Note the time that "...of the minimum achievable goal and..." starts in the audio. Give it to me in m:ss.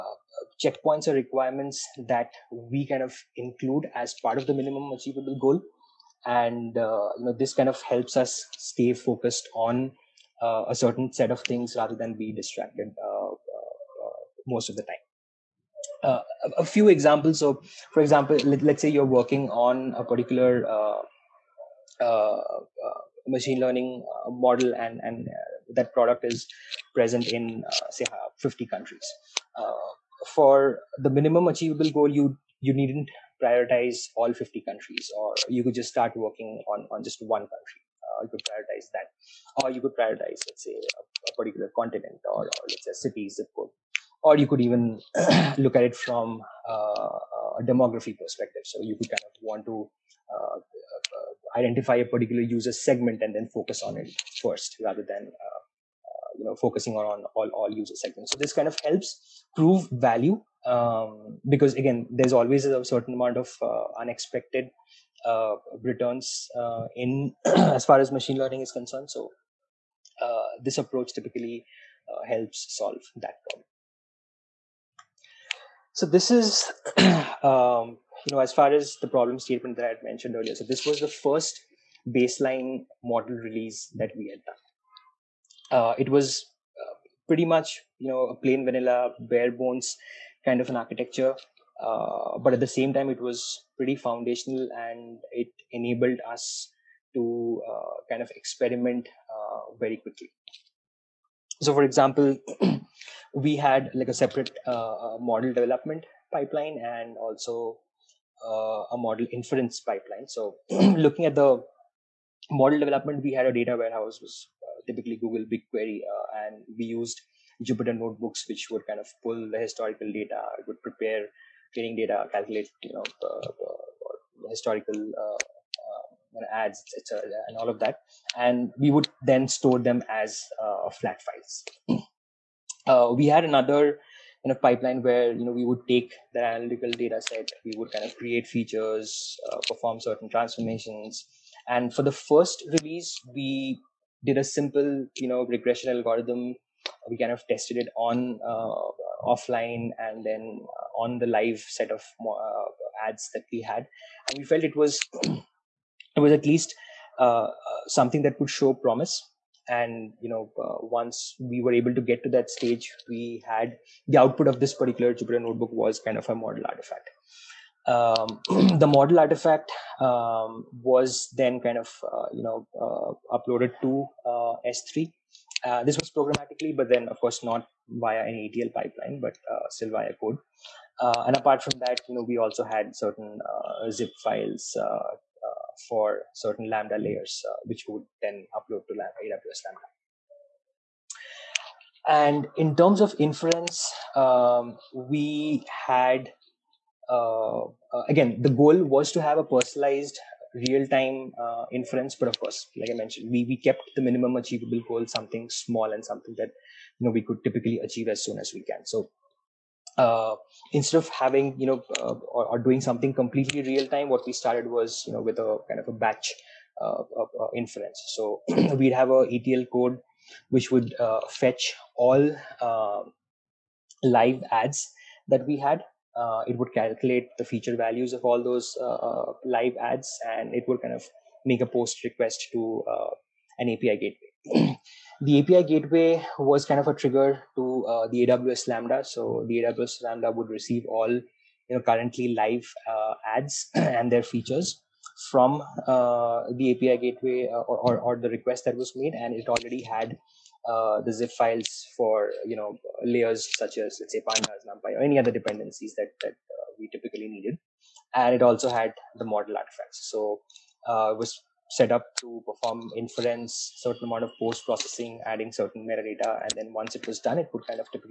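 0:04.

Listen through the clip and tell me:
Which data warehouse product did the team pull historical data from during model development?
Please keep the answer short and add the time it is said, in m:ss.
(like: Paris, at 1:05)
Google BigQuery, at 1:55.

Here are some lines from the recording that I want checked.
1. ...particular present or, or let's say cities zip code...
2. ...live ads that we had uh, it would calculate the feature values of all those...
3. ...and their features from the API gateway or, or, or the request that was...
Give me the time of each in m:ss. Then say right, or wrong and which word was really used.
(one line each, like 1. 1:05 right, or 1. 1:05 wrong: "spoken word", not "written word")
1. 0:41 wrong: "continent", not "present"
2. 3:44 right
3. 4:03 right.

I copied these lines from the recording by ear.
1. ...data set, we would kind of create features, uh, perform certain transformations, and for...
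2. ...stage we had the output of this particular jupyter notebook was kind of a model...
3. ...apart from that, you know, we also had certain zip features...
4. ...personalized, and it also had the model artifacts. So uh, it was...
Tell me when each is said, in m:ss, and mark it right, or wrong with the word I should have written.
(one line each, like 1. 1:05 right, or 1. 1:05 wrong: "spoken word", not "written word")
1. 2:16 right
2. 2:42 right
3. 3:01 wrong: "files", not "features"
4. 4:17 wrong: "needed", not "personalized".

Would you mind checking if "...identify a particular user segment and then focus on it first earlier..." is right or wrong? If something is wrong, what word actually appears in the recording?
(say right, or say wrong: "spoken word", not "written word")
wrong: "rather", not "earlier".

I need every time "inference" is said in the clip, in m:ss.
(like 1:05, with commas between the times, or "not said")
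1:49, 3:13, 3:21, 3:37, 4:22.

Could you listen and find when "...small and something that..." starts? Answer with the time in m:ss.
3:25.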